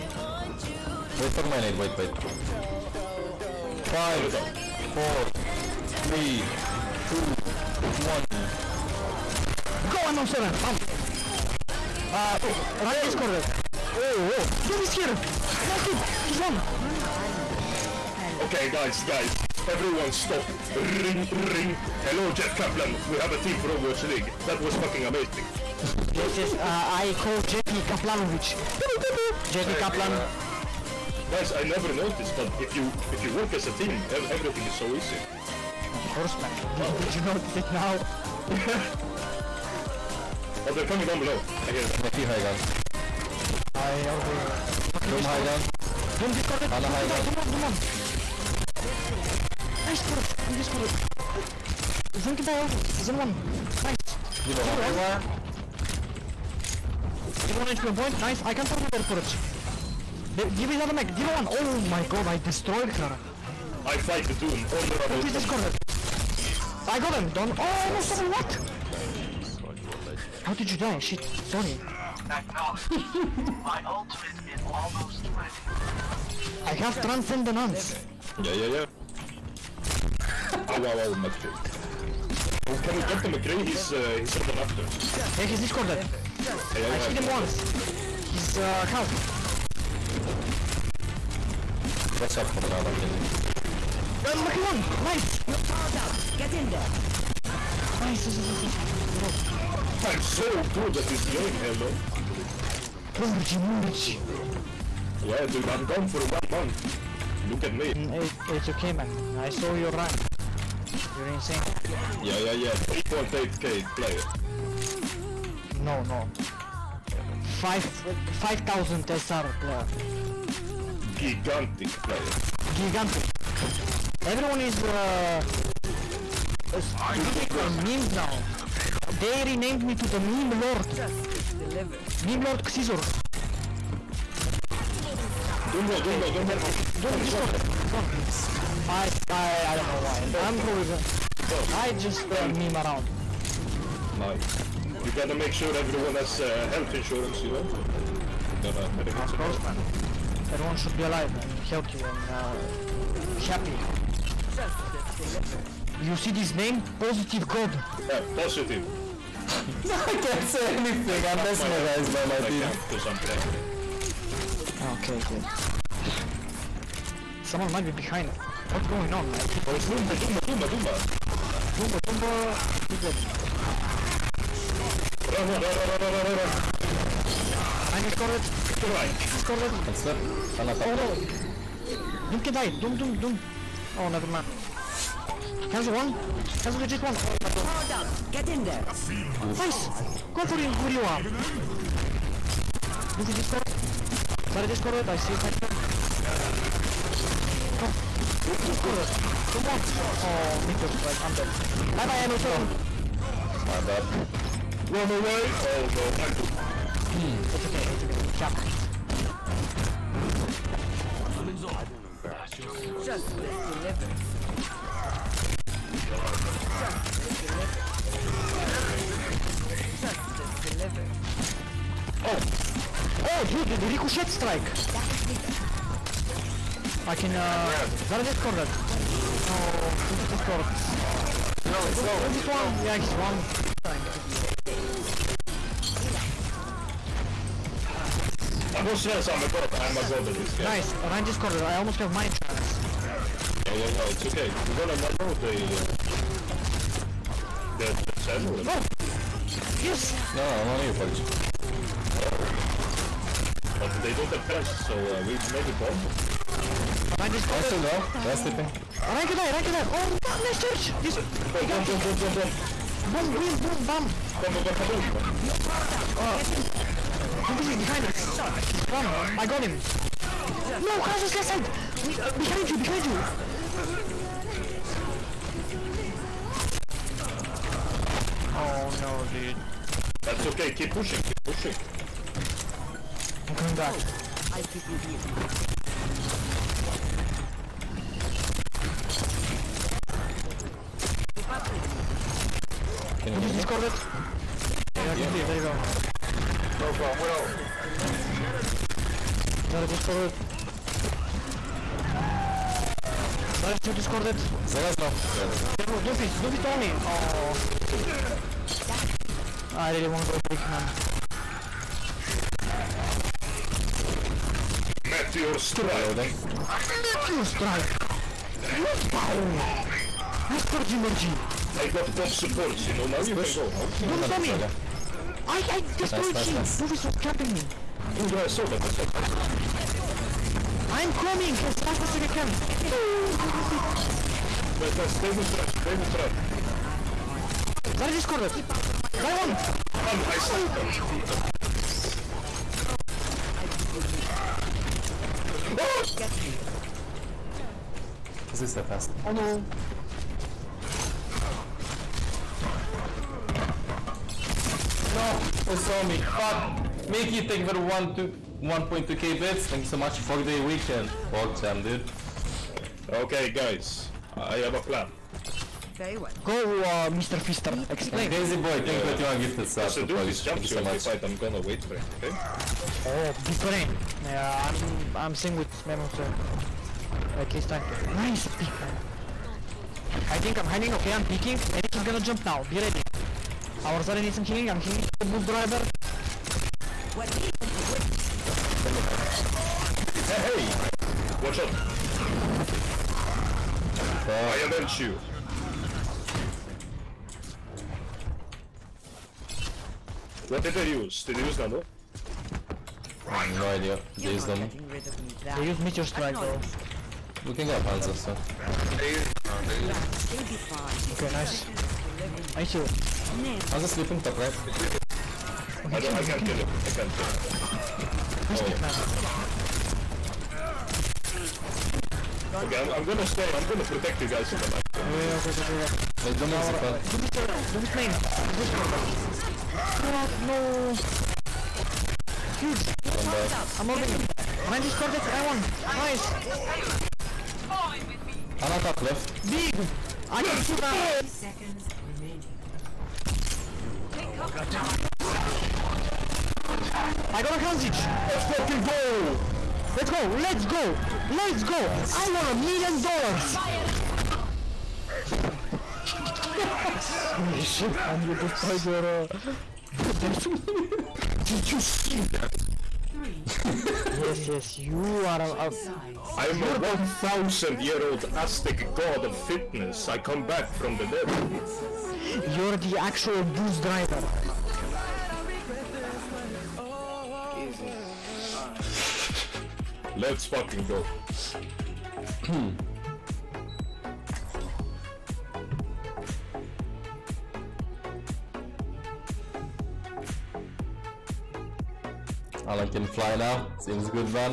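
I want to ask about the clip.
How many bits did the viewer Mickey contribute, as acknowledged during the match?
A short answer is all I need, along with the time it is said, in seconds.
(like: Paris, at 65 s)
1.2k, at 357 s.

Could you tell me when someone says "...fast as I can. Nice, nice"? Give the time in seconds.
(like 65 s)
331 s.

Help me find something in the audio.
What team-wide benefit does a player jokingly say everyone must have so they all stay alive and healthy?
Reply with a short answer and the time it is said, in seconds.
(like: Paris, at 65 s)
Health insurance, at 146 s.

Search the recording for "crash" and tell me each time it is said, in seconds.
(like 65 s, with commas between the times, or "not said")
271 s.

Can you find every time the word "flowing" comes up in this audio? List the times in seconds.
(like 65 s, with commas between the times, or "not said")
not said.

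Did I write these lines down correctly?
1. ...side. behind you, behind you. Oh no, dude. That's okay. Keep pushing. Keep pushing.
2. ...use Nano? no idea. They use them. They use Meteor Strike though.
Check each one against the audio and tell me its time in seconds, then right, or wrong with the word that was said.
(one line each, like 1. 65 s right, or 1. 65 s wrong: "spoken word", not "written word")
1. 271 s right
2. 401 s right.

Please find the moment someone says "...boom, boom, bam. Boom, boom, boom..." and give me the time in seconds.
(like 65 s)
263 s.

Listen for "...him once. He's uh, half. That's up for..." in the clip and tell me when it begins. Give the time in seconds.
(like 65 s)
87 s.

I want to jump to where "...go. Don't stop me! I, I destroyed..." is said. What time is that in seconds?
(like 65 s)
323 s.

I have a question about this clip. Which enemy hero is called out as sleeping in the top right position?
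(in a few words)
Hanzo.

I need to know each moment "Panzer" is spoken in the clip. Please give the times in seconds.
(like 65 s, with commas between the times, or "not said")
407 s.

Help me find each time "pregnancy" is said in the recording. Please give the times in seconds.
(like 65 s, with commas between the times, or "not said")
not said.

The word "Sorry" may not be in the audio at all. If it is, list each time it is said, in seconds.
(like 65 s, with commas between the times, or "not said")
71 s, 194 s.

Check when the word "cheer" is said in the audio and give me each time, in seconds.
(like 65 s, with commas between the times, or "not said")
not said.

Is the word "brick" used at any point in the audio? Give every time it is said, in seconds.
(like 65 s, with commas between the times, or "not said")
310 s.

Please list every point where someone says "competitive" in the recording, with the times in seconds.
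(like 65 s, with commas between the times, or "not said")
not said.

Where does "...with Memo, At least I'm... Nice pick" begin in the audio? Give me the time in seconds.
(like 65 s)
375 s.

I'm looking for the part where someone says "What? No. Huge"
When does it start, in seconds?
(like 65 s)
430 s.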